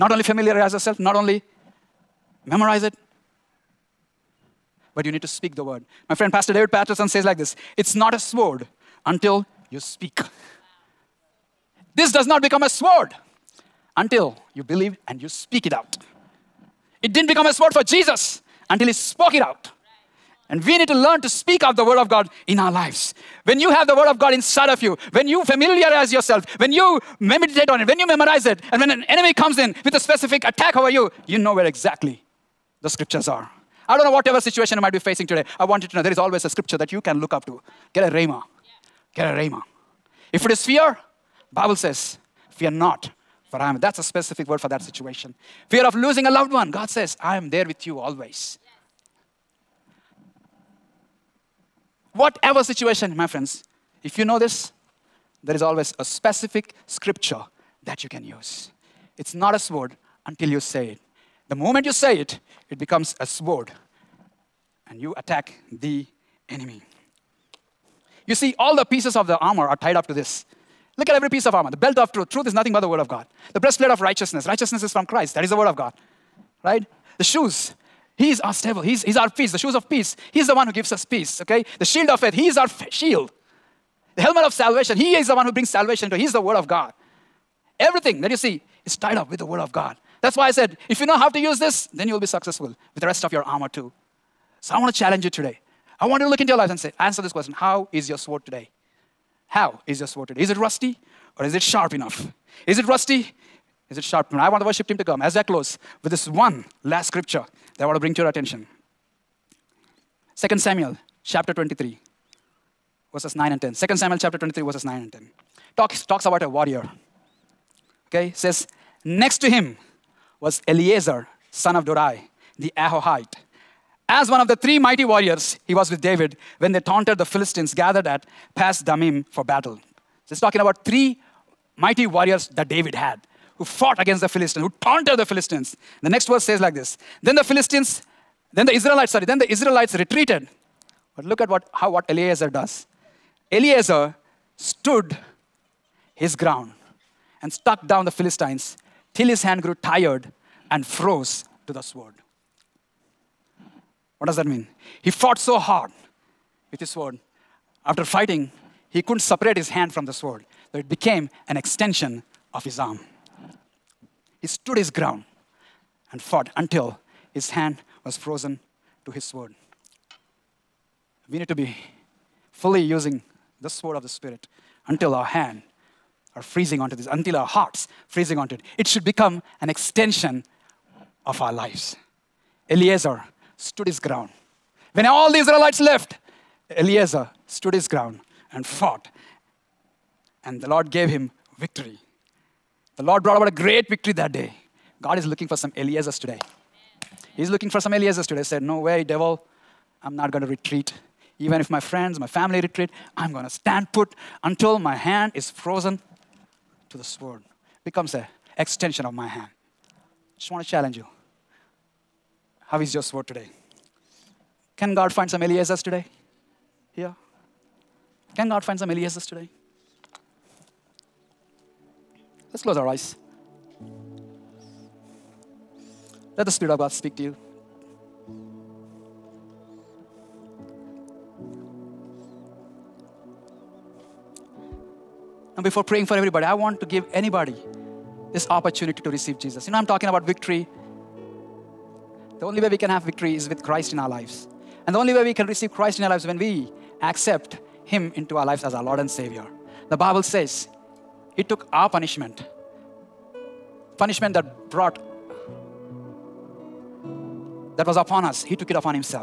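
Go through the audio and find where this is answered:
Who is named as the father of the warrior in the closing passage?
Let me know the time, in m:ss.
2:01.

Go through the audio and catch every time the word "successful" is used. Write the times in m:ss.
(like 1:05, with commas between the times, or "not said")
1:32.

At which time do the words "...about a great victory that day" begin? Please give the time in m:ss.
3:13.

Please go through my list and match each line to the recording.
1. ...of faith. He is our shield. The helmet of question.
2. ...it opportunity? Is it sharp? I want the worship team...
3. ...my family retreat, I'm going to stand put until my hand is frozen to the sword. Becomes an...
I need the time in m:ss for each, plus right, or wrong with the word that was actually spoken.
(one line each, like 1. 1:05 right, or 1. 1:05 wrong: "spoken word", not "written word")
1. 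1:22 wrong: "salvation", not "question"
2. 1:42 wrong: "rusty", not "opportunity"
3. 3:22 right.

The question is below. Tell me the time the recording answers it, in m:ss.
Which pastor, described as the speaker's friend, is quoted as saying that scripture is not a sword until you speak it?
0:06.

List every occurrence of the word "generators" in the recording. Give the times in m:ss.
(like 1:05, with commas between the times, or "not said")
not said.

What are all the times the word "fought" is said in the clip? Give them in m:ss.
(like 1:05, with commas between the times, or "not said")
2:13, 2:35, 2:46, 3:08.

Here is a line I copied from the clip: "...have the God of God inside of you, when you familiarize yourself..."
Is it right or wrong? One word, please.
wrong.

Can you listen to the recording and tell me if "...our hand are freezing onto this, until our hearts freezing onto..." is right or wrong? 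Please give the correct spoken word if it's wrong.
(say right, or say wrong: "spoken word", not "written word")
right.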